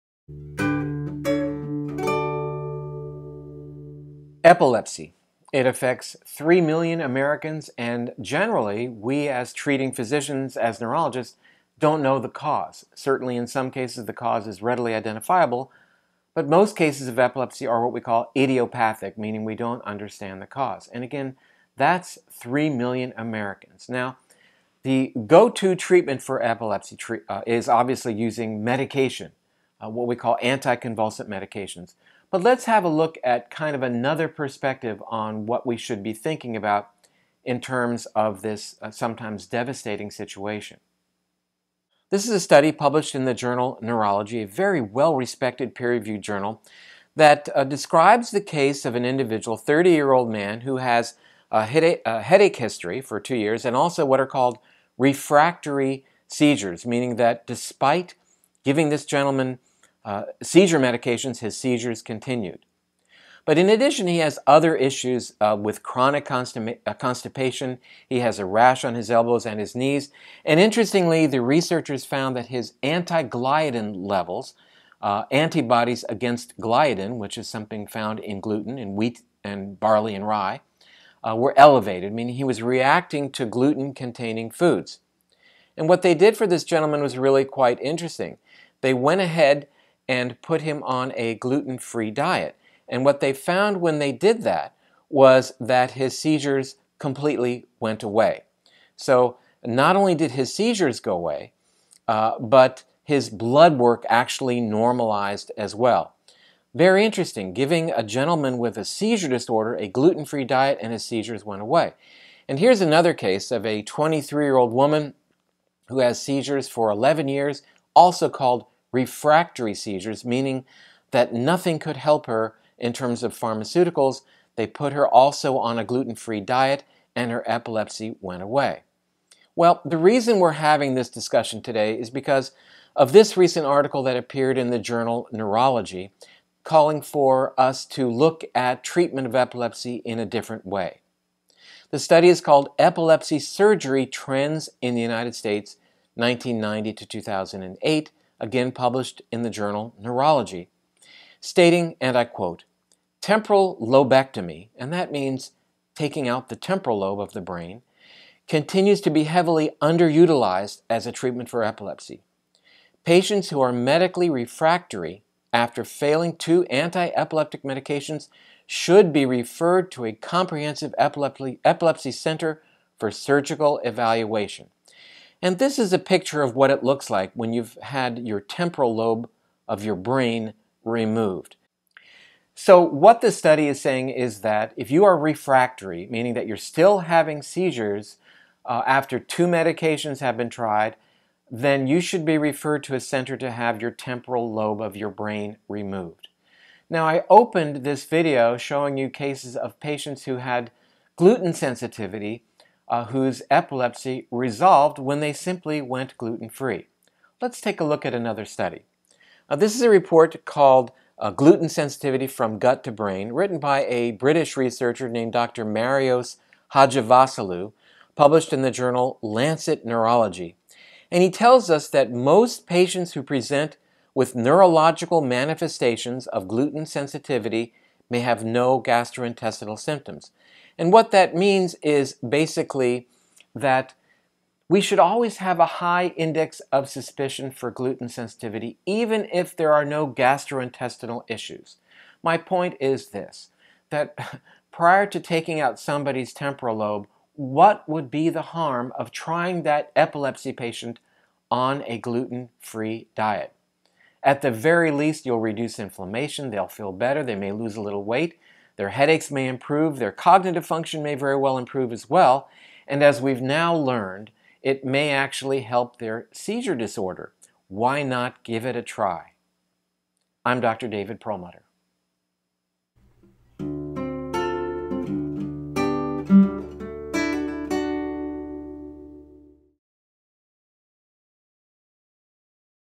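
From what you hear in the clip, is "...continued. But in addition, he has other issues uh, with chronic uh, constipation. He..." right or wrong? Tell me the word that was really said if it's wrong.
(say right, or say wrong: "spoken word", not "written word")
right.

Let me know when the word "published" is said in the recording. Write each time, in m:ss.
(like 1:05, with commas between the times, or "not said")
0:42, 2:28, 3:38.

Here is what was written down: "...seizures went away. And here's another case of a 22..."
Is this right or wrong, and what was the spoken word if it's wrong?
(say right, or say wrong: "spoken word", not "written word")
wrong: "23", not "22".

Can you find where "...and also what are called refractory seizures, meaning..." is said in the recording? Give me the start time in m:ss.
0:53.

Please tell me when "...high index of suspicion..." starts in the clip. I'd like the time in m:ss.
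3:55.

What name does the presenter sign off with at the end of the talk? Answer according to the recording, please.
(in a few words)
David Perlmutter.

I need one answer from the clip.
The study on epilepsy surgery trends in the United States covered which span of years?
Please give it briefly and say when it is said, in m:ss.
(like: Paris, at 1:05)
1990 to 2008, at 2:26.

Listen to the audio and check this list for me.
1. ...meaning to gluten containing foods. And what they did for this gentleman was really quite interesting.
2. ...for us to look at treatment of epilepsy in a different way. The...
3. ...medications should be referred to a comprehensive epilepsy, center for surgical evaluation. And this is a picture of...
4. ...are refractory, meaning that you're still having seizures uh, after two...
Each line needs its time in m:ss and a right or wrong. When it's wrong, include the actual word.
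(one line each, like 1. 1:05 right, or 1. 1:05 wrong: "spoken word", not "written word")
1. 1:22 wrong: "reacting", not "meaning"
2. 2:17 right
3. 2:47 right
4. 3:05 right.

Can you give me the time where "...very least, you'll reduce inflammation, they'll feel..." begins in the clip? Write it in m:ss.
4:14.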